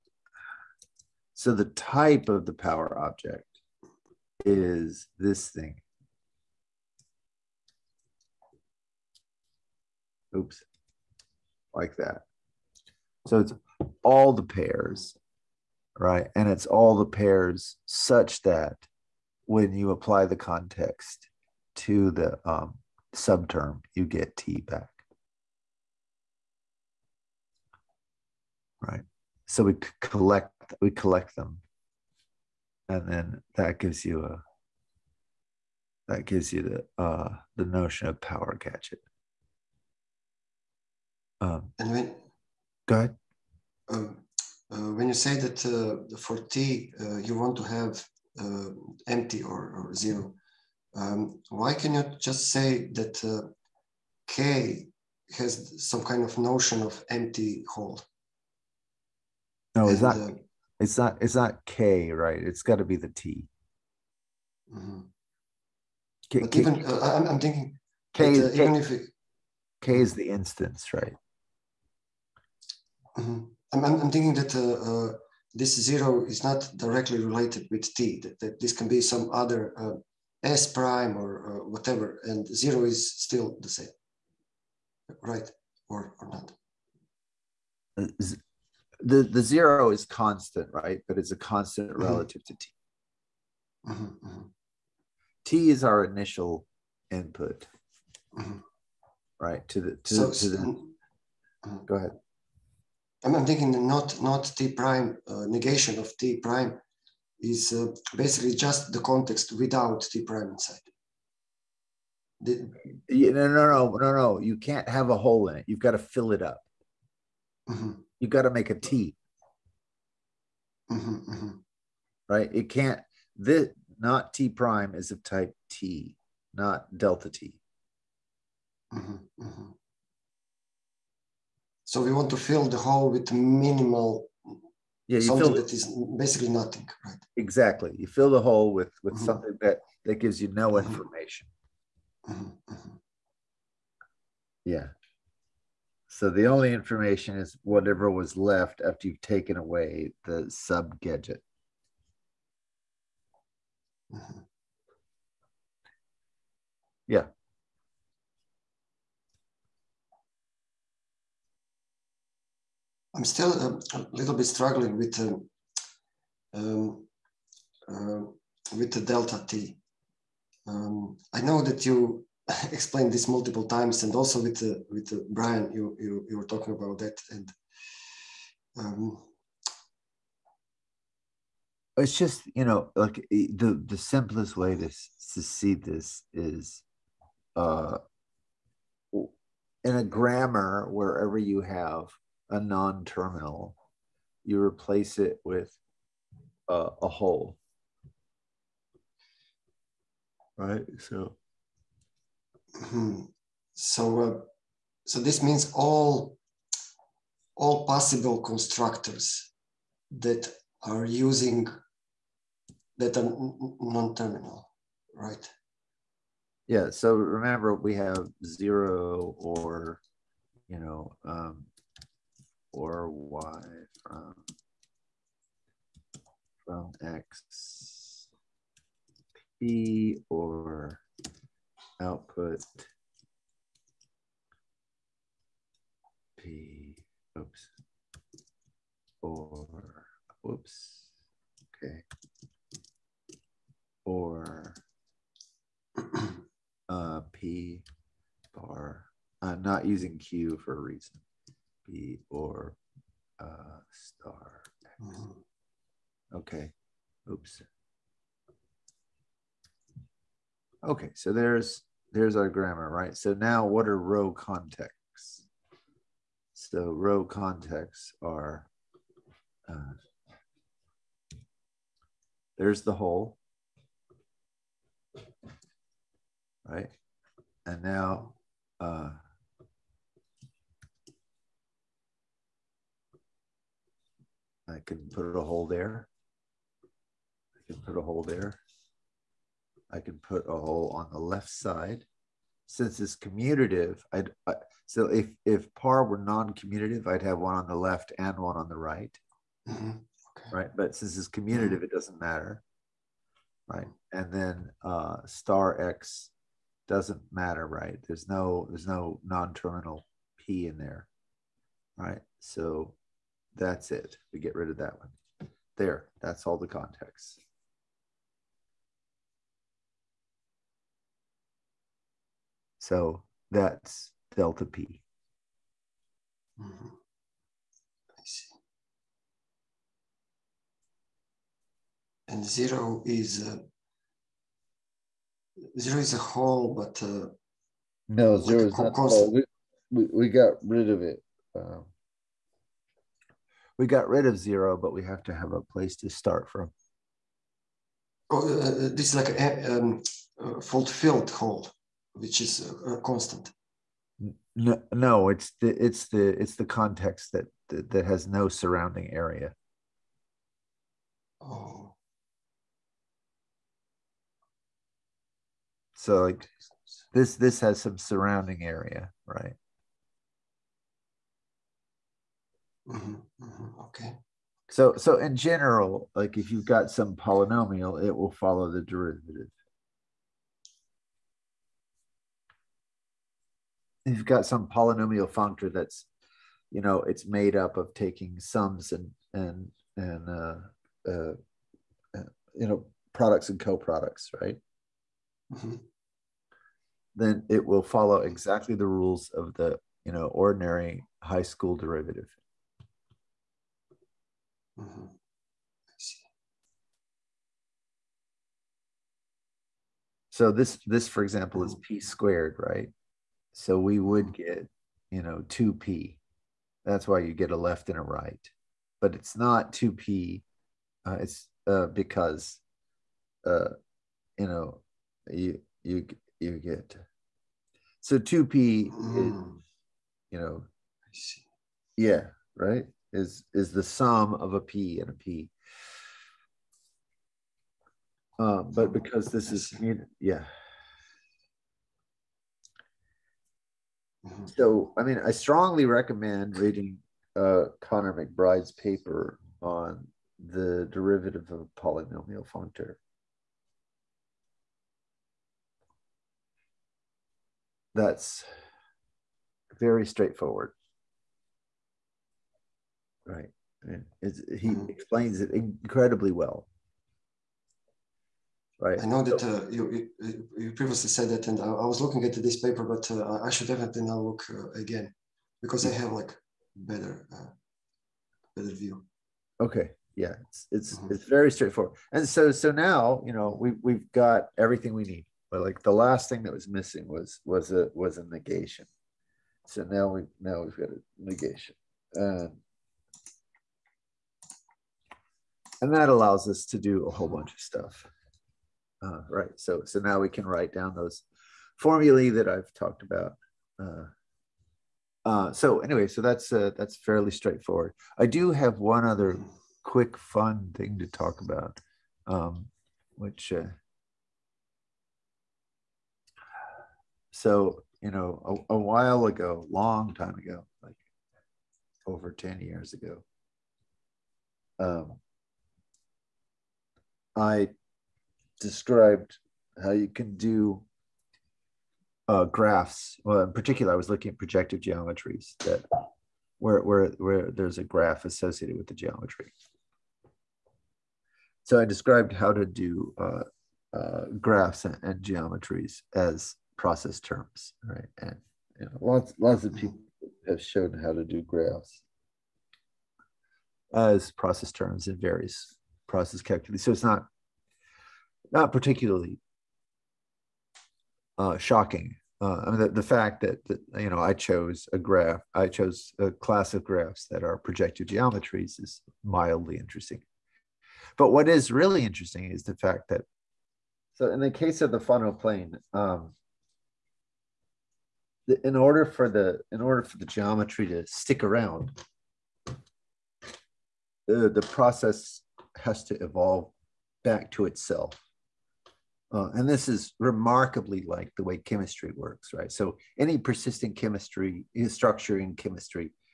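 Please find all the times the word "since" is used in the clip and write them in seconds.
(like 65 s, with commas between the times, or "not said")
292 s, 300 s.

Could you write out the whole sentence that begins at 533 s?
Well, in particular, I was looking at projective geometries that where, where, where there's a graph associated with the geometry.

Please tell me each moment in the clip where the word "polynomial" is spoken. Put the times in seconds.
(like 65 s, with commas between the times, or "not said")
377 s, 384 s, 451 s.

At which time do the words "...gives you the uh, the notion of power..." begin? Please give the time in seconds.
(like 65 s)
36 s.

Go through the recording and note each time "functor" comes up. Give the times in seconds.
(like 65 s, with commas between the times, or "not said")
385 s, 452 s.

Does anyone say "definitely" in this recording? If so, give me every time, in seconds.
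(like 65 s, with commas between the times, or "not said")
473 s.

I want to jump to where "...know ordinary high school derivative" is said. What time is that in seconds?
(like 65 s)
400 s.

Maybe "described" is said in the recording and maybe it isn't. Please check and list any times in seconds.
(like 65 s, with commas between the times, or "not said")
528 s, 541 s.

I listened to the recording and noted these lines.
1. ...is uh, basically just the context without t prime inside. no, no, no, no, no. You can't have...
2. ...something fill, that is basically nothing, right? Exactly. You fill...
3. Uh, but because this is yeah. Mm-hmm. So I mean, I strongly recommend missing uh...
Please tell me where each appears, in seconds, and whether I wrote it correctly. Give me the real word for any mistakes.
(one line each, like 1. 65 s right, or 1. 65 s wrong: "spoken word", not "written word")
1. 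107 s right
2. 135 s right
3. 438 s wrong: "reading", not "missing".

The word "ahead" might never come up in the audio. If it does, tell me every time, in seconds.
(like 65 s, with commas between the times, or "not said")
42 s, 101 s.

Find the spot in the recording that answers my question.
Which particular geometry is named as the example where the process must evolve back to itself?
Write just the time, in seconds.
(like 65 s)
574 s.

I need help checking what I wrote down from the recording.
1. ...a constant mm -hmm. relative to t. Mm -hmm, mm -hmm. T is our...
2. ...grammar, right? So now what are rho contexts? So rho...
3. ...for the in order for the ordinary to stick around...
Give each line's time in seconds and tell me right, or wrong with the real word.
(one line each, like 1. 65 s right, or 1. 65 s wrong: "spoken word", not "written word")
1. 91 s right
2. 262 s right
3. 579 s wrong: "geometry", not "ordinary".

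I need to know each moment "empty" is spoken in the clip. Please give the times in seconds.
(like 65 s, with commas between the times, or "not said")
49 s, 57 s.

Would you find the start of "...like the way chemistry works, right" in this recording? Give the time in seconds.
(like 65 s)
591 s.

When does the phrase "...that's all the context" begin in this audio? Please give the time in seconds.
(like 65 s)
316 s.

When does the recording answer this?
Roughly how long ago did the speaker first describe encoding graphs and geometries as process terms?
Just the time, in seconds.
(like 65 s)
522 s.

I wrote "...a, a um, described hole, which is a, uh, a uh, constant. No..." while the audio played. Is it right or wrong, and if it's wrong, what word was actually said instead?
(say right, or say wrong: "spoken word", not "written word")
wrong: "fulfilled", not "described".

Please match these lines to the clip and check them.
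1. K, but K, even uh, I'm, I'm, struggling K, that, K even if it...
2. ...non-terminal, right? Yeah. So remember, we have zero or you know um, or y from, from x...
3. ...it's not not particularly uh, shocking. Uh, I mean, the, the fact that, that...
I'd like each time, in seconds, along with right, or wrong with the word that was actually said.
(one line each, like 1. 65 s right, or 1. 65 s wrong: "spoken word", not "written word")
1. 66 s wrong: "thinking", not "struggling"
2. 213 s right
3. 556 s right.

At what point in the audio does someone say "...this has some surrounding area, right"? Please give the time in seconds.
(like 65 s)
367 s.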